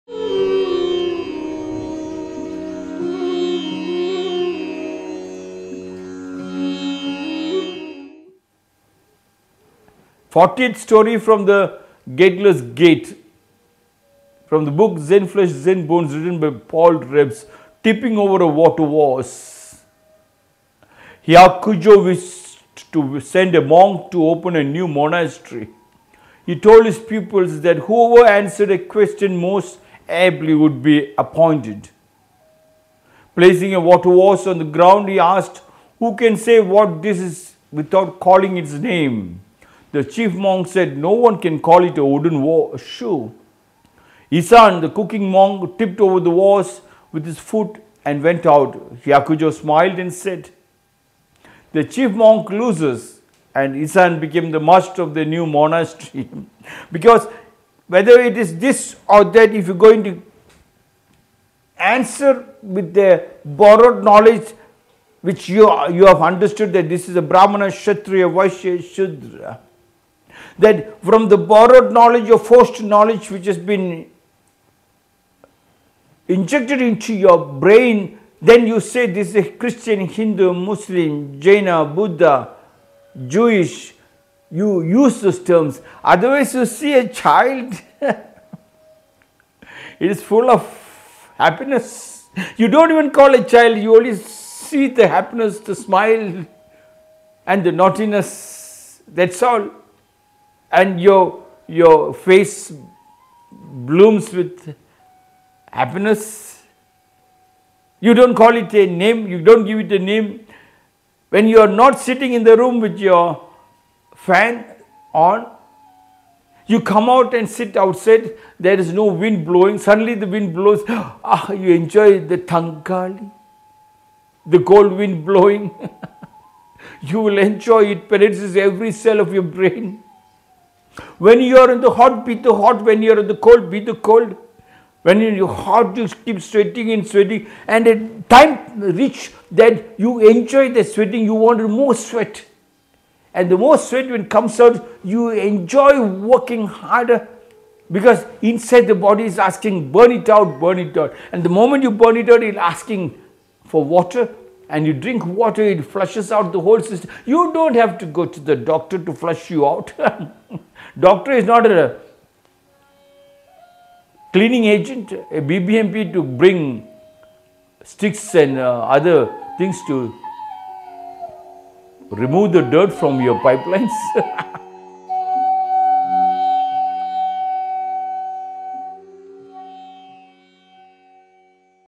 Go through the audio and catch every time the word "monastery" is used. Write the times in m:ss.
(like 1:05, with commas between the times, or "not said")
0:24, 0:55.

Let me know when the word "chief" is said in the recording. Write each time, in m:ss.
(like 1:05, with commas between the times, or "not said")
0:40, 0:51.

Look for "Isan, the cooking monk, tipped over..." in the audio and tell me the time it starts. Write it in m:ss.
0:44.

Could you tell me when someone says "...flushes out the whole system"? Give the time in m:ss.
2:35.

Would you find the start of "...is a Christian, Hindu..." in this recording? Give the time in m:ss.
1:19.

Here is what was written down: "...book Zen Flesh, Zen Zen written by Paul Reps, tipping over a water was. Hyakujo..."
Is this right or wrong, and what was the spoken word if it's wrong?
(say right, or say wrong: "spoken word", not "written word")
wrong: "Bones", not "Zen".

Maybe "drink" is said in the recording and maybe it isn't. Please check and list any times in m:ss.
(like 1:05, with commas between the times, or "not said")
2:34.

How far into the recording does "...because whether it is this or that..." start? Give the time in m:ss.
0:56.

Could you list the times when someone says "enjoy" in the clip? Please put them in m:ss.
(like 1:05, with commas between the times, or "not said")
2:01, 2:07, 2:20, 2:25.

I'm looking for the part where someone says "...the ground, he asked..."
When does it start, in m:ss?
0:34.